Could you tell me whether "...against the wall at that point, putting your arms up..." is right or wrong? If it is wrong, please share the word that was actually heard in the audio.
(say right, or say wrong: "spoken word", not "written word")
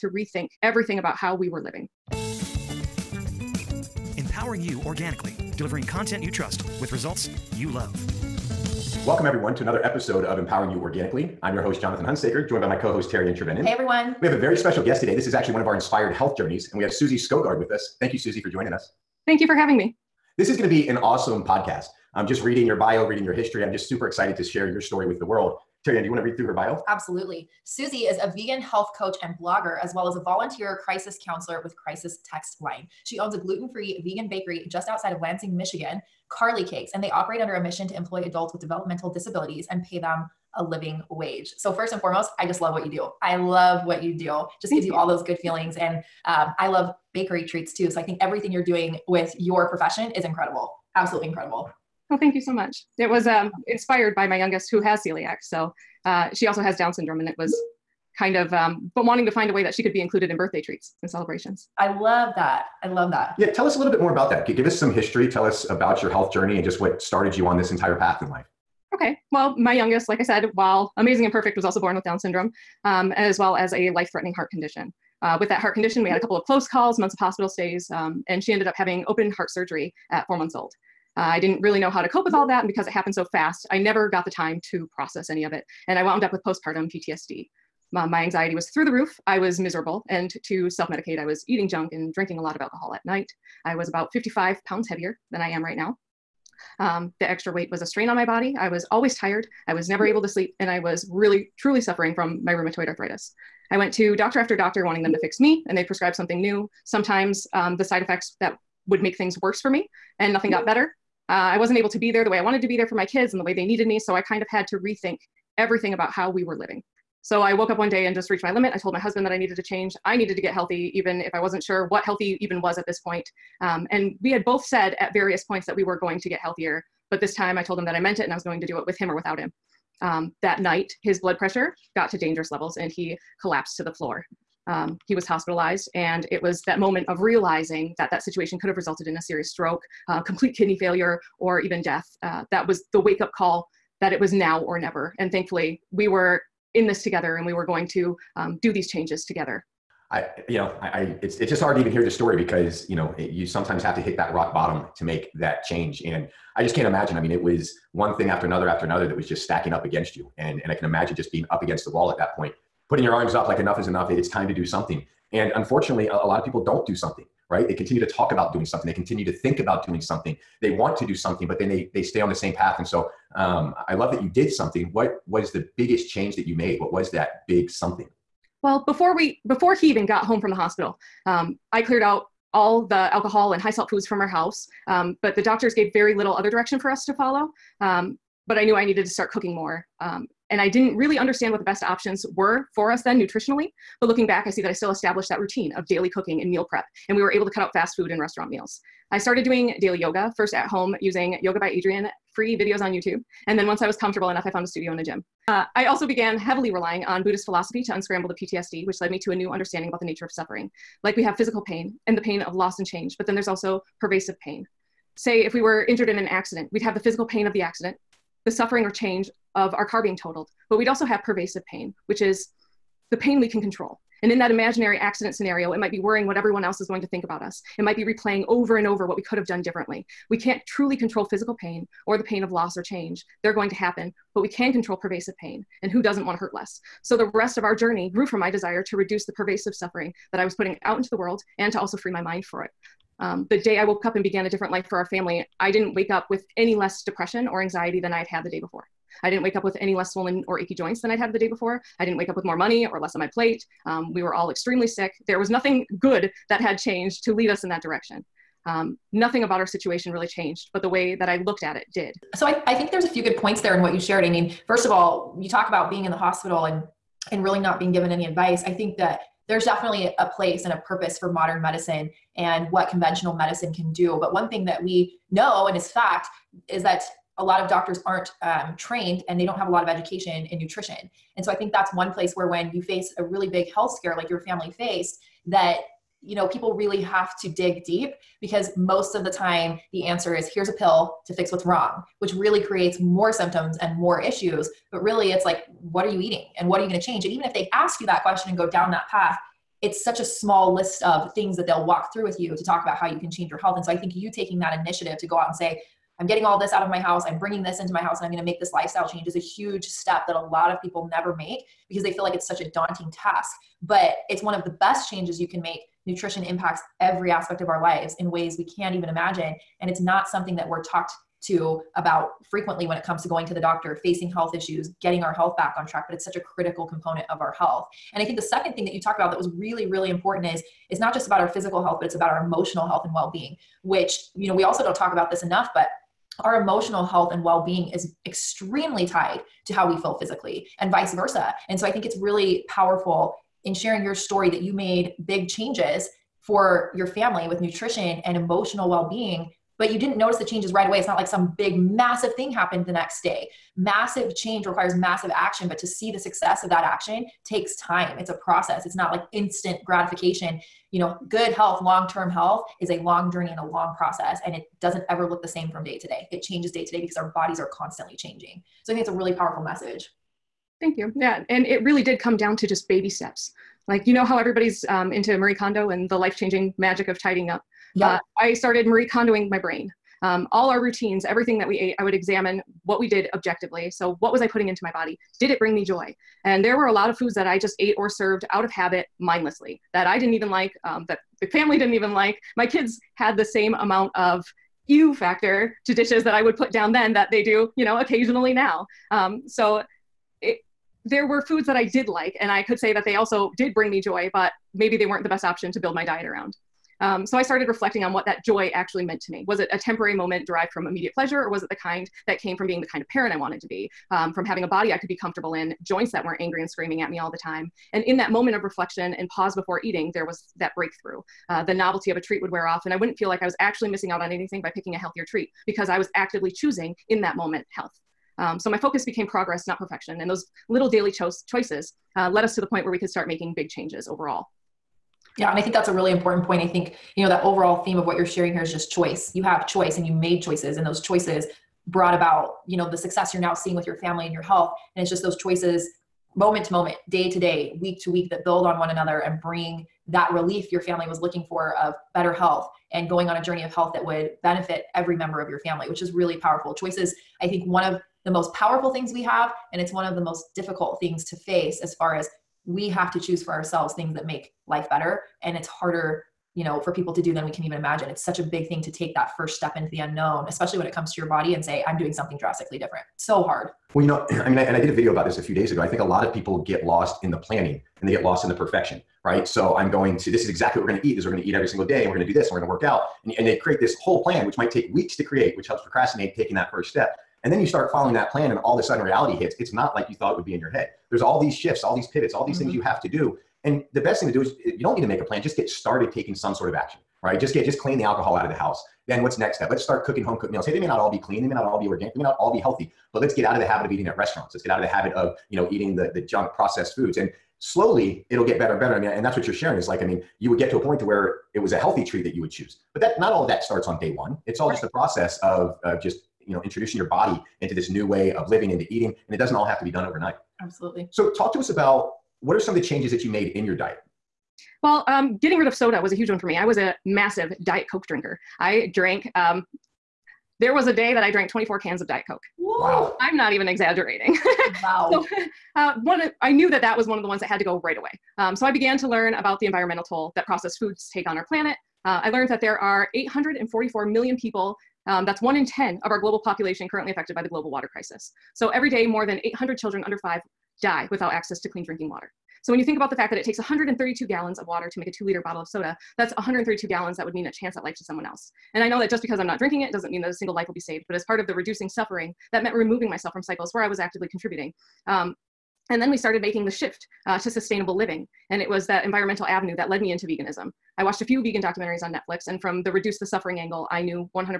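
right.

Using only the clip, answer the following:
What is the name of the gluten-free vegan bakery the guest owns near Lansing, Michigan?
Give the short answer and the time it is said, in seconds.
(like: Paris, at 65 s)
Carly Cakes, at 36 s.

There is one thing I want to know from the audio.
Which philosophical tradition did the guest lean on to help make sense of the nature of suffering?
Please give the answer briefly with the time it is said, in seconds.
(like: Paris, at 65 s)
Buddhist philosophy, at 207 s.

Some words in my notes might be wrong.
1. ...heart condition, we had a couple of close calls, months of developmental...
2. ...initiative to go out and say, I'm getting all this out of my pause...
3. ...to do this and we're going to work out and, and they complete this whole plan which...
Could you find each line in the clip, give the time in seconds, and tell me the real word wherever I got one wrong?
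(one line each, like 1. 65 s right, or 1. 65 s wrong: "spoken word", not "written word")
1. 75 s wrong: "hospital", not "developmental"
2. 304 s wrong: "house", not "pause"
3. 482 s wrong: "create", not "complete".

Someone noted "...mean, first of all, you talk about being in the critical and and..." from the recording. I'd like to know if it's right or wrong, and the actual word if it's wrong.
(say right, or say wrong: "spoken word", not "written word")
wrong: "hospital", not "critical".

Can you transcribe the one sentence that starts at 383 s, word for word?
So, what was I putting into my body?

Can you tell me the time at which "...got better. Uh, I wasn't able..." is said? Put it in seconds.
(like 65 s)
110 s.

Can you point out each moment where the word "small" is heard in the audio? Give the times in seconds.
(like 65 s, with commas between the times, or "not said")
300 s.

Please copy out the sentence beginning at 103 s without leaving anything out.
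I went to doctor after doctor wanting them to fix me, and they prescribed something new.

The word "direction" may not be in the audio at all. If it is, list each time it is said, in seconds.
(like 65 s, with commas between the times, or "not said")
186 s, 257 s.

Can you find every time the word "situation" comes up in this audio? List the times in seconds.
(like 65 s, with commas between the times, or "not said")
138 s, 259 s.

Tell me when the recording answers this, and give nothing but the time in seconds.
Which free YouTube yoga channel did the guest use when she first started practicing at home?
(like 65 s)
201 s.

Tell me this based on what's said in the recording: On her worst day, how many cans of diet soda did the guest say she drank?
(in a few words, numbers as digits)
24.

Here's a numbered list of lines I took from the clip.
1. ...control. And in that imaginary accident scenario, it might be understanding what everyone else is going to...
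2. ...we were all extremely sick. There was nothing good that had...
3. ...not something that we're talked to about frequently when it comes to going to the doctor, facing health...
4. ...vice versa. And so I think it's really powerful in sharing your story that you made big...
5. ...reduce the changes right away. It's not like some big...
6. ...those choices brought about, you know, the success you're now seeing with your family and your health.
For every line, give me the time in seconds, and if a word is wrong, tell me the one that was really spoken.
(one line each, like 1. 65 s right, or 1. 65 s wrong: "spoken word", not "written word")
1. 223 s wrong: "worrying", not "understanding"
2. 254 s right
3. 319 s right
4. 340 s right
5. 350 s wrong: "notice", not "reduce"
6. 440 s right.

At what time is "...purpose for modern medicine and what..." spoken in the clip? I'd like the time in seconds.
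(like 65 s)
270 s.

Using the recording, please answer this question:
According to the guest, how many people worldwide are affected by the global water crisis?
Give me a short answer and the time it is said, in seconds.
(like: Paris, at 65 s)
844 million, at 543 s.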